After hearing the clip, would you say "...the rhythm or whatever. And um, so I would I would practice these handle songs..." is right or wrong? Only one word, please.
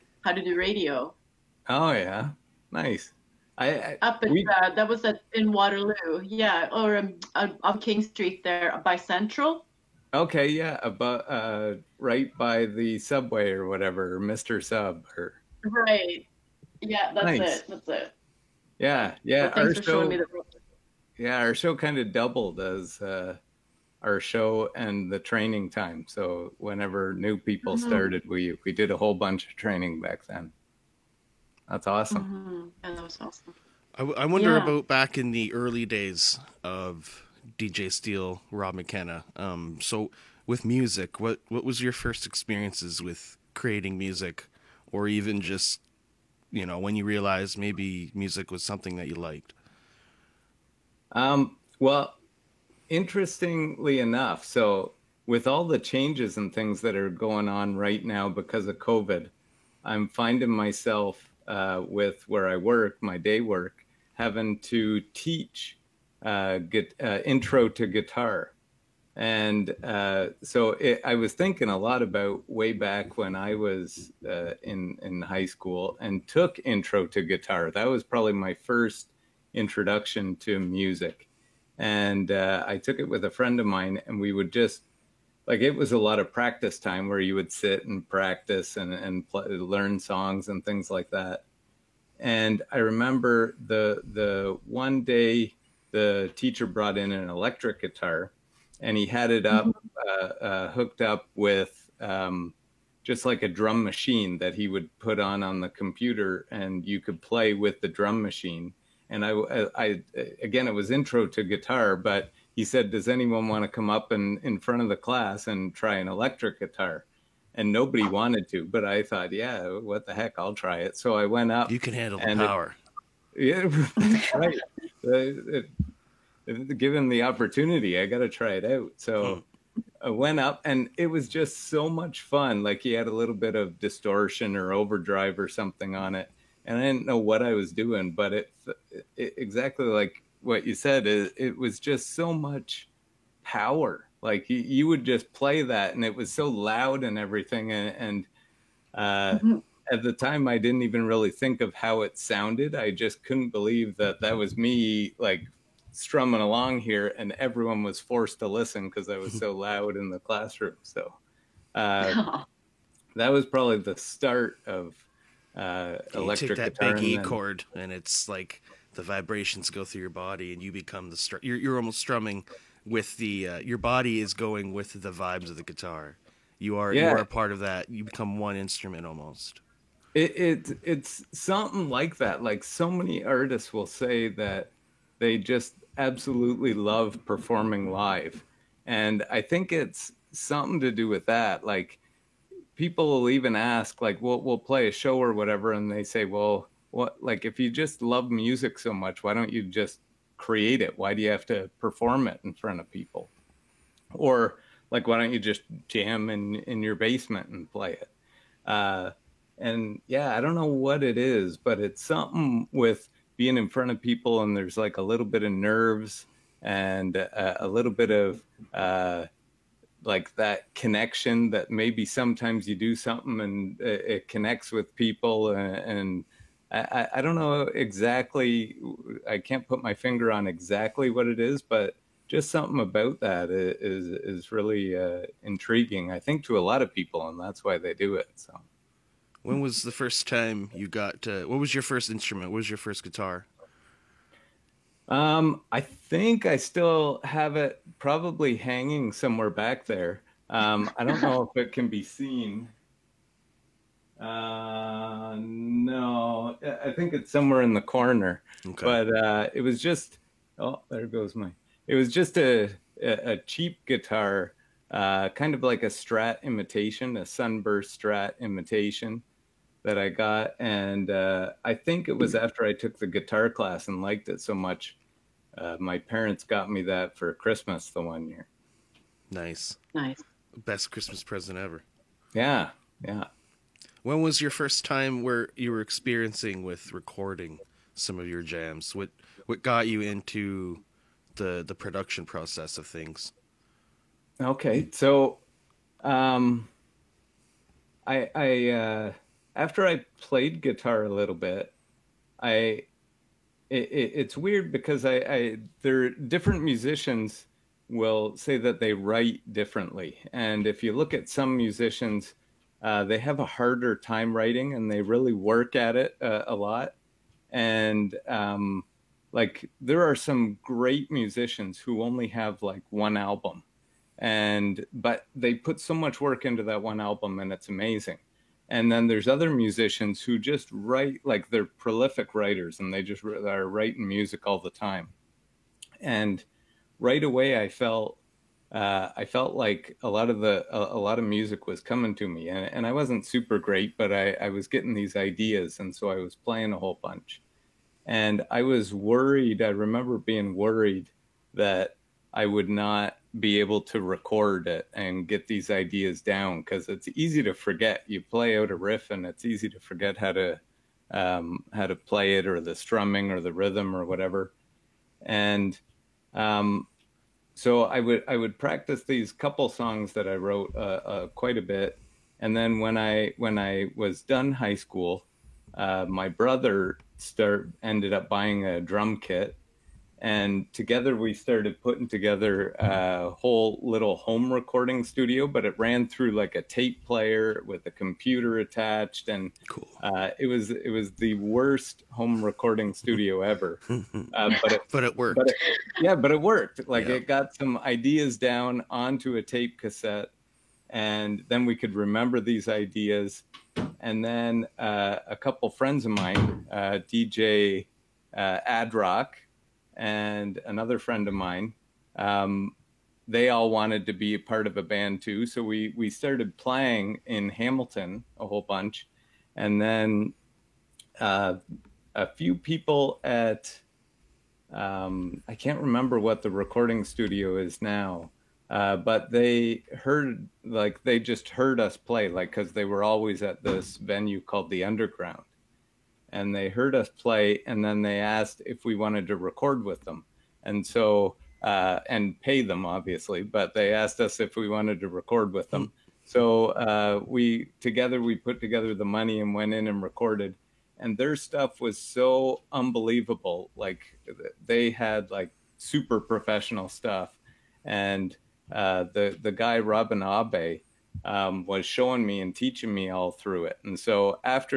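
wrong.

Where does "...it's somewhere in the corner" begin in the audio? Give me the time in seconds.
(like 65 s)
257 s.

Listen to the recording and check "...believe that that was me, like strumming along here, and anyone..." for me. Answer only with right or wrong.
wrong.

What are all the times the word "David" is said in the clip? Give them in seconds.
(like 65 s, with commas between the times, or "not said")
not said.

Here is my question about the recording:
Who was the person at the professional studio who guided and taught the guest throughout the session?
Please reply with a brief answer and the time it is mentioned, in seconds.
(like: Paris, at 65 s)
Robin Abe, at 459 s.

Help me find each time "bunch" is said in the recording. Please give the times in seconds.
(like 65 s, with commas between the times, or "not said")
29 s, 347 s, 418 s.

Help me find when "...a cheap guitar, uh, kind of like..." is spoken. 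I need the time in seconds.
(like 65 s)
263 s.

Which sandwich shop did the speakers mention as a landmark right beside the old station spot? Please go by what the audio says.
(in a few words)
Mister Sub.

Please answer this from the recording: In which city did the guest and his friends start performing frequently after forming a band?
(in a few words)
Hamilton.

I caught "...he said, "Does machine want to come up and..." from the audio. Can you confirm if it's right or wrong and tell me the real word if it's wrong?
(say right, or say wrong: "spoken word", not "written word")
wrong: "anyone", not "machine".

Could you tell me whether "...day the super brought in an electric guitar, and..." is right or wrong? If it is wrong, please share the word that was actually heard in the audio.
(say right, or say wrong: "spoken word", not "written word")
wrong: "teacher", not "super".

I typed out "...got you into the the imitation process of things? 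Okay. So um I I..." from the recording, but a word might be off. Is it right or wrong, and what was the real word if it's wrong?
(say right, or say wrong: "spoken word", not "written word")
wrong: "production", not "imitation".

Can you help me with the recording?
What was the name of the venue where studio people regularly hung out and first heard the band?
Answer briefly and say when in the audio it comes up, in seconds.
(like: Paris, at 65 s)
The Underground, at 434 s.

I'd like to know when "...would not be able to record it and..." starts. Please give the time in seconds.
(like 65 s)
352 s.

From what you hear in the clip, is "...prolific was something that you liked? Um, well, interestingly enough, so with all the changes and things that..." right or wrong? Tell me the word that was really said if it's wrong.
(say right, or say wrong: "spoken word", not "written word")
wrong: "music", not "prolific".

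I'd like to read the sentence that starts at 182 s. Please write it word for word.
Like so many artists will say that they just absolutely love performing live, and I think it's something to do with that.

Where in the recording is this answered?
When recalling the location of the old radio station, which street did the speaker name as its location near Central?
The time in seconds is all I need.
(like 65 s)
7 s.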